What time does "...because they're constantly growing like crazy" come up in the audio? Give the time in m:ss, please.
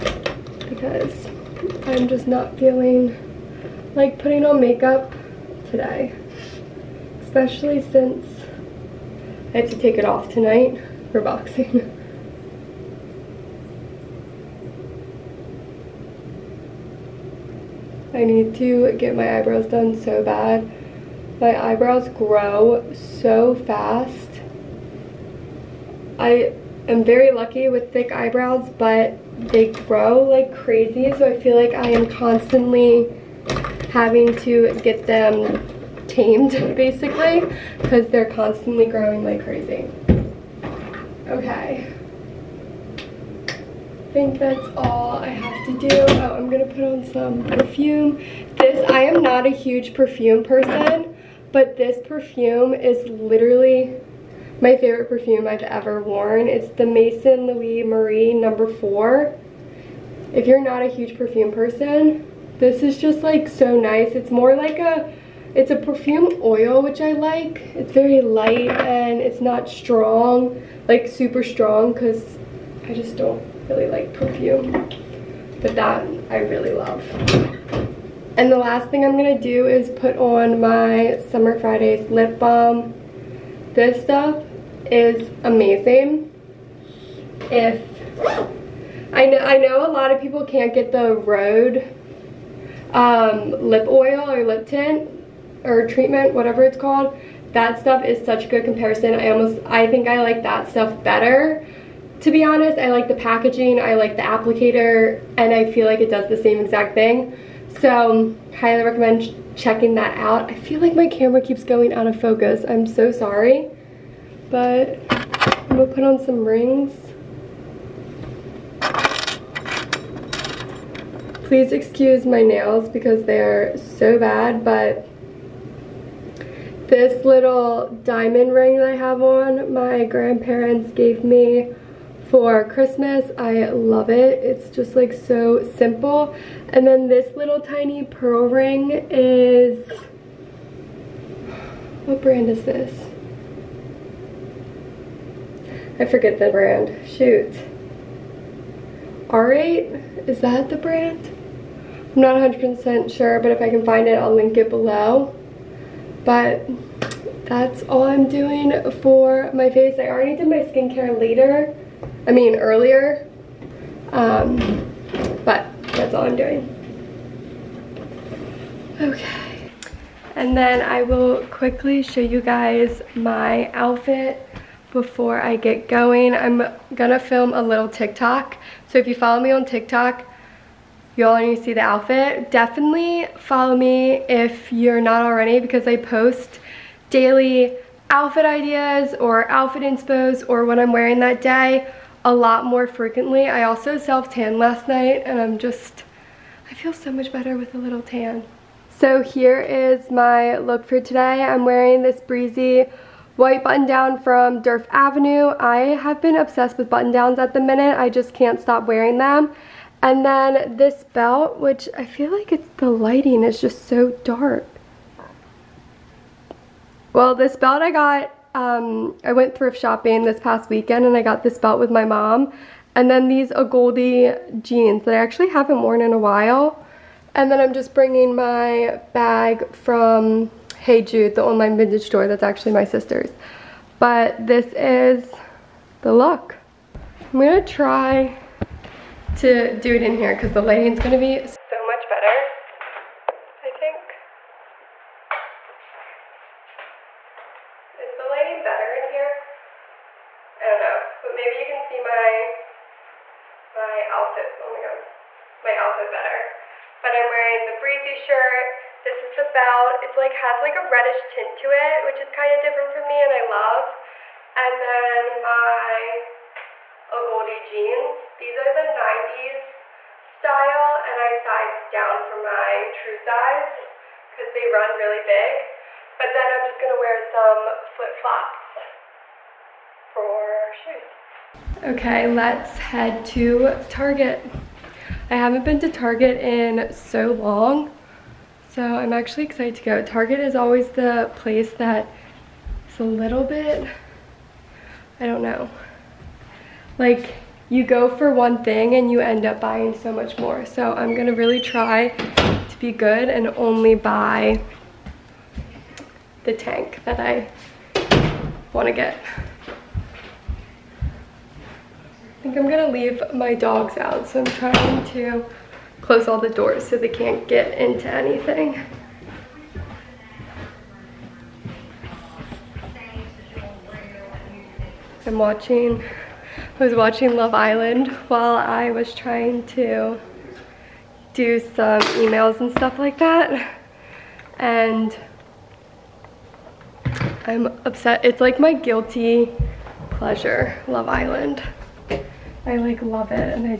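0:37.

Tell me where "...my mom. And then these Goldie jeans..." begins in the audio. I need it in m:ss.
3:41.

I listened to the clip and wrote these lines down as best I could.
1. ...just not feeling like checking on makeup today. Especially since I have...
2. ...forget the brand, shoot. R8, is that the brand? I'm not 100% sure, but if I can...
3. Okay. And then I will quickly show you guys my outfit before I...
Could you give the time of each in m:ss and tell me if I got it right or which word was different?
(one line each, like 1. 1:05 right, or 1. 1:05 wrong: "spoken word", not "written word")
1. 0:02 wrong: "putting", not "checking"
2. 2:26 right
3. 2:48 right.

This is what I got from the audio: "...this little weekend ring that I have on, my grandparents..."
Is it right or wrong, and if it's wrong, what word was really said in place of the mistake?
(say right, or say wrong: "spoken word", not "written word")
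wrong: "diamond", not "weekend".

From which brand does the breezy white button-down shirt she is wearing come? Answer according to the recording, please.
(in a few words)
Durf Avenue.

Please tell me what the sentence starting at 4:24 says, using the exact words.
And then my a goldie jeans.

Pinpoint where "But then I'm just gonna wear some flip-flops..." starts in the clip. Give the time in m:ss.
4:36.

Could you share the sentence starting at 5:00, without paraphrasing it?
So I'm gonna really try to be good and only buy the tank that I wanna get.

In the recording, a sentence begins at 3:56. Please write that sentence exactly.
I'm gonna try to do it in here because the lighting's gonna be so much better, I think.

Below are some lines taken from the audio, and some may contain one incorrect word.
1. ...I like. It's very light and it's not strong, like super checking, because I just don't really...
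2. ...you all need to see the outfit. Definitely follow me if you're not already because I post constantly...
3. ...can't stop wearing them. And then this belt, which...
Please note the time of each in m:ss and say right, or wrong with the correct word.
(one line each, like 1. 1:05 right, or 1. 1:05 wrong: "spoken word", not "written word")
1. 1:06 wrong: "strong", not "checking"
2. 3:01 wrong: "daily", not "constantly"
3. 3:28 right.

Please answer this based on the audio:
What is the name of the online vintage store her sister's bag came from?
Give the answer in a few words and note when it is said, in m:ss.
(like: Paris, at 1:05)
Hey Jude, at 3:50.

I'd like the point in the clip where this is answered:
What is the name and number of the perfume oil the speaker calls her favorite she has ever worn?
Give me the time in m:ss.
0:56.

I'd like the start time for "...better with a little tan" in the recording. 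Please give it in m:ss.
3:17.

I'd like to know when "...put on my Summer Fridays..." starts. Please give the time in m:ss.
1:19.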